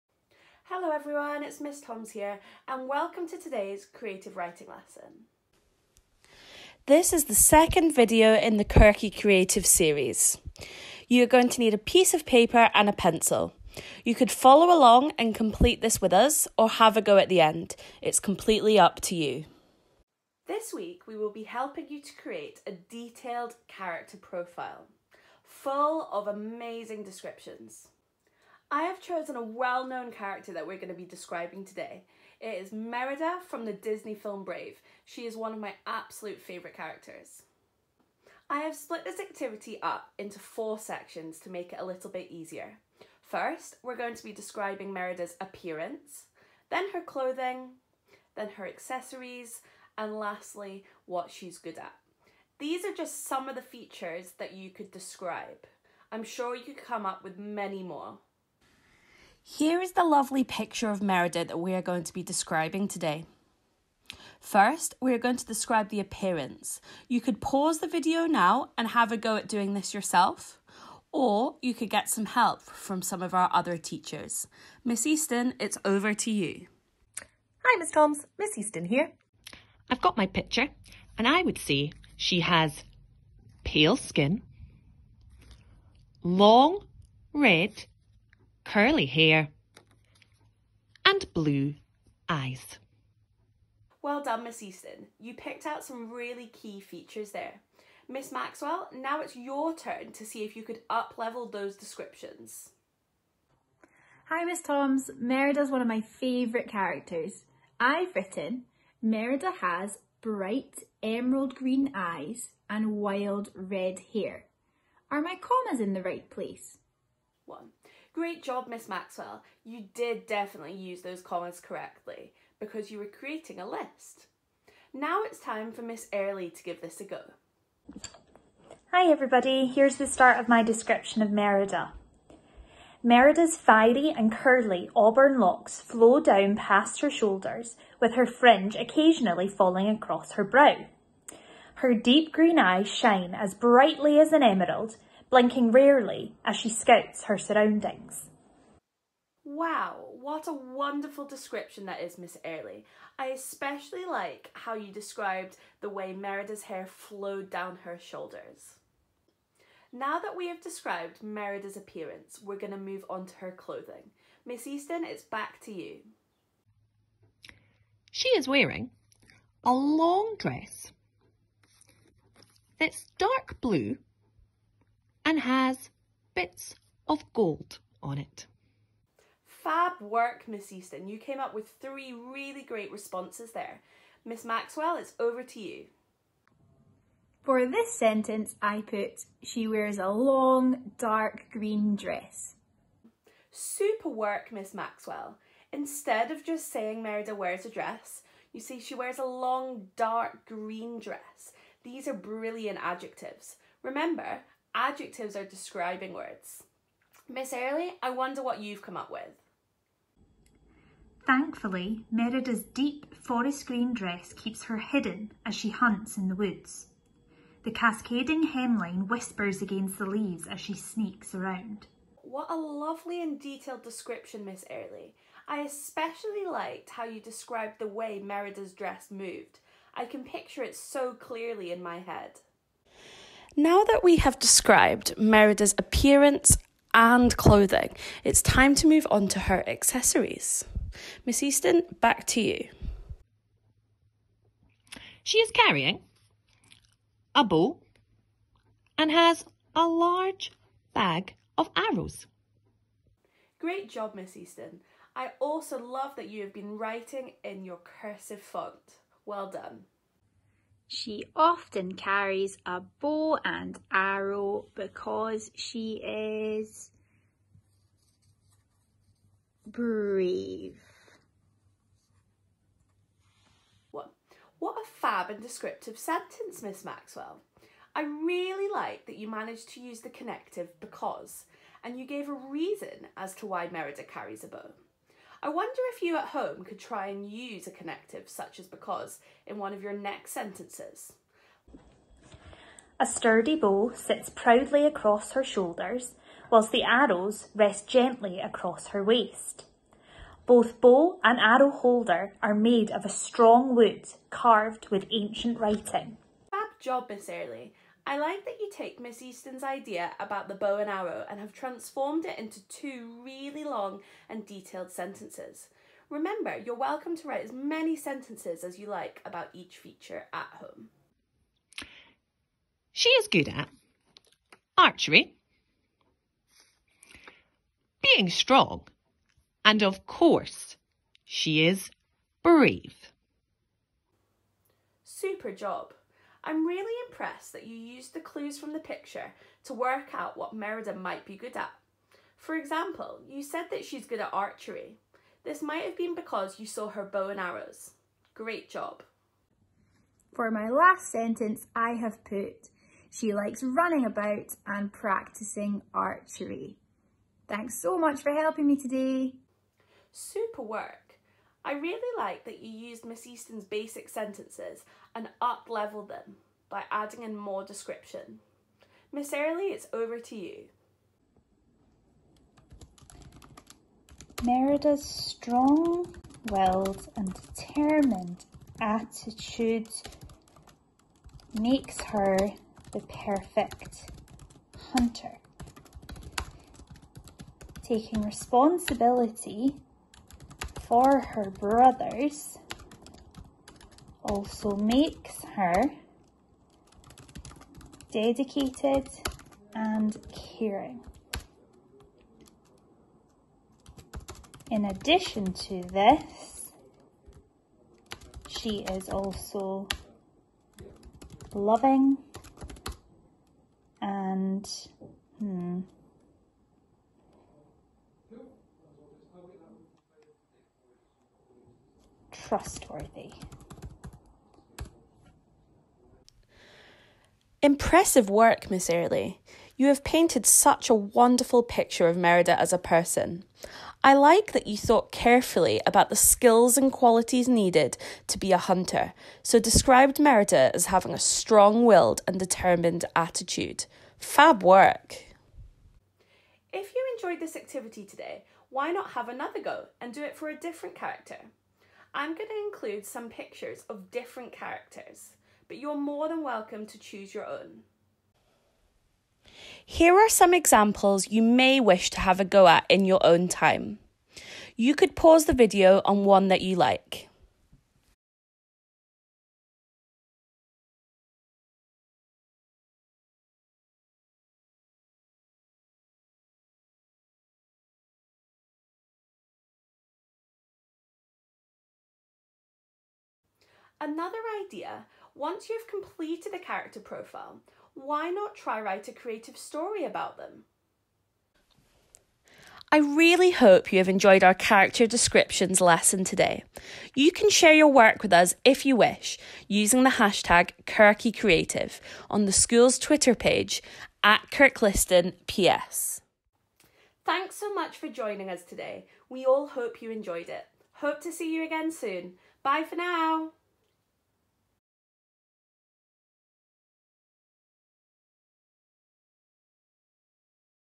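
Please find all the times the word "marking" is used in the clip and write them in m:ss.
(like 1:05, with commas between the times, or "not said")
not said.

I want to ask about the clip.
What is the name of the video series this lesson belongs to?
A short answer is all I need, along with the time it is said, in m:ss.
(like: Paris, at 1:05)
Kirky Creative, at 0:08.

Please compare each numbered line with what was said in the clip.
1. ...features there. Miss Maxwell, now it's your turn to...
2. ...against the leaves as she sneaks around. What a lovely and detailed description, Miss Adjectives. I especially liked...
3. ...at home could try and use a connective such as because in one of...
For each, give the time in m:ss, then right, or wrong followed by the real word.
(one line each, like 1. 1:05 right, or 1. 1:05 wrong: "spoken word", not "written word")
1. 1:36 right
2. 3:39 wrong: "Airlie", not "Adjectives"
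3. 4:46 right.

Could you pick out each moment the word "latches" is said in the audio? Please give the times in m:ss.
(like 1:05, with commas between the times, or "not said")
not said.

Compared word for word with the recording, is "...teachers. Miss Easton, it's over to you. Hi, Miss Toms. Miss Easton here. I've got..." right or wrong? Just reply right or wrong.
right.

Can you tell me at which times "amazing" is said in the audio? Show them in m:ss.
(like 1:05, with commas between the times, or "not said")
0:26.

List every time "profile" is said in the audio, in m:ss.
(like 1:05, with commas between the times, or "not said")
0:24, 8:06.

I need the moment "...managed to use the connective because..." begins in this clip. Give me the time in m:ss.
4:39.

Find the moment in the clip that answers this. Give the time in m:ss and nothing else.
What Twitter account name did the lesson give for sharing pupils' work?
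8:24.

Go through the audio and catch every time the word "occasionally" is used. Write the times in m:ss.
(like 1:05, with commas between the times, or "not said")
2:18.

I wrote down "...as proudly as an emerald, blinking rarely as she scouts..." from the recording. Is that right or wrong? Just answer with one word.
wrong.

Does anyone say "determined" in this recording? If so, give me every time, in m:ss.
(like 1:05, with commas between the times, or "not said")
6:17, 7:22.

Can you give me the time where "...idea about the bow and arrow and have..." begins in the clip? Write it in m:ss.
5:09.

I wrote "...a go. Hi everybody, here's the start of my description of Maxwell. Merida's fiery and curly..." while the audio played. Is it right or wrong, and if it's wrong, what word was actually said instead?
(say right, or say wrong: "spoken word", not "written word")
wrong: "Merida", not "Maxwell".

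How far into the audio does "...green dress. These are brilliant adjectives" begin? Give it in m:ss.
3:20.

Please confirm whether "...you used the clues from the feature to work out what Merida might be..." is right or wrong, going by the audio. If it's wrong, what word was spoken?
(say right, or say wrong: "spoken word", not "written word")
wrong: "picture", not "feature".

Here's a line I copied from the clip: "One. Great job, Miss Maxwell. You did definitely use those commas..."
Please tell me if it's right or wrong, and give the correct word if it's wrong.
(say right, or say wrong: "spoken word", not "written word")
right.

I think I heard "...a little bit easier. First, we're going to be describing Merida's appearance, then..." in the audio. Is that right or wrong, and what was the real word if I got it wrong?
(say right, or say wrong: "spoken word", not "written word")
right.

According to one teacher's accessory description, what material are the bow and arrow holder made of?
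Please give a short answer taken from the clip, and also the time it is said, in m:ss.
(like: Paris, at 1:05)
wood, at 5:03.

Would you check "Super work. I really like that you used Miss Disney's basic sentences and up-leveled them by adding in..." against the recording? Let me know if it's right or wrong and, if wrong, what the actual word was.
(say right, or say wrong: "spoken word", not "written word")
wrong: "Easton", not "Disney".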